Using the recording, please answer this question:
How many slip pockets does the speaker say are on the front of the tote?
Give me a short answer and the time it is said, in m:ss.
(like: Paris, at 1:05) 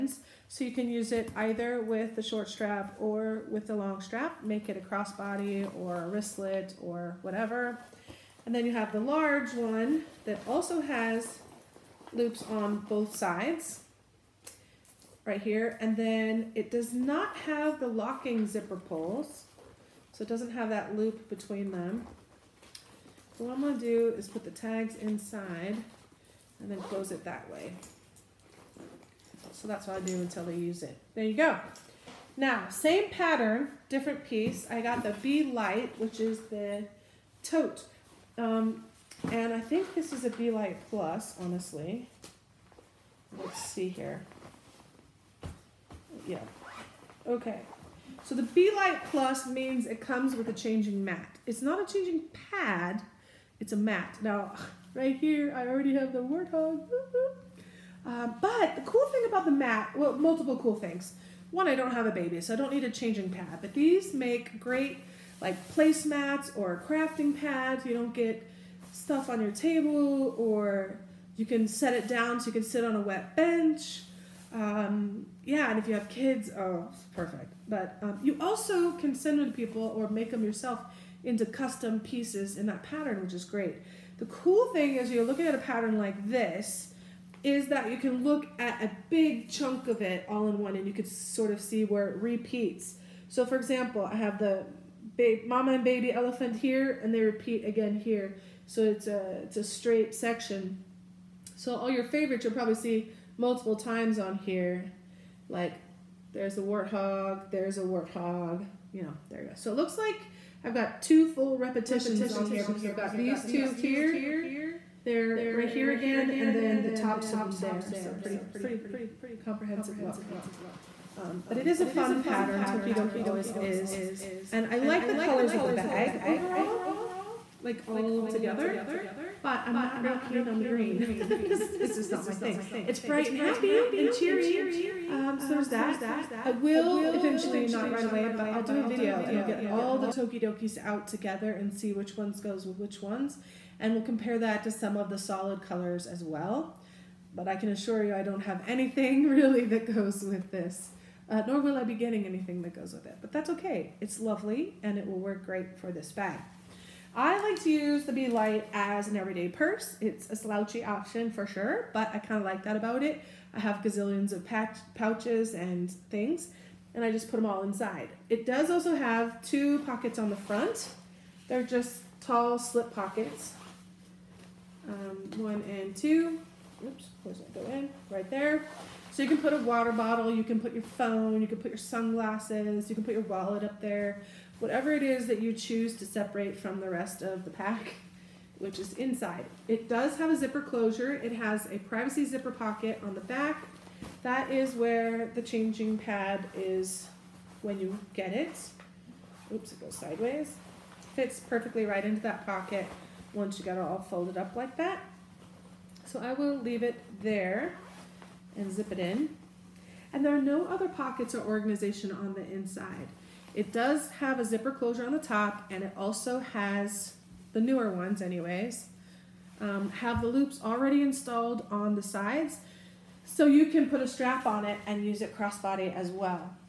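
2, at 2:49.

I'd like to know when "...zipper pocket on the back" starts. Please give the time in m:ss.
3:12.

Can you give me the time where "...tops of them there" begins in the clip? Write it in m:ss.
1:56.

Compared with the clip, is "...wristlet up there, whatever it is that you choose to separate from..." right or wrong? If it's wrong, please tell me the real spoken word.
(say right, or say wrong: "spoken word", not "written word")
wrong: "wallet", not "wristlet".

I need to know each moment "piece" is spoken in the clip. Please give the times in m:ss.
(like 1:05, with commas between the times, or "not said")
0:34, 1:21.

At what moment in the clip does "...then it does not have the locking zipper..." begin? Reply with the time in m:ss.
0:15.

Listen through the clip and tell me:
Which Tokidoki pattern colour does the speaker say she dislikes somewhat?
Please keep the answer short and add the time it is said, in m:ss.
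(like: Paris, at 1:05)
green, at 2:10.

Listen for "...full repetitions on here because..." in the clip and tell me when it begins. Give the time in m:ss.
1:51.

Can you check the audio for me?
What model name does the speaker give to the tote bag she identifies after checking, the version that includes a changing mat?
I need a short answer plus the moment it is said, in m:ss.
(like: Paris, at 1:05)
Be Light Plus, at 0:48.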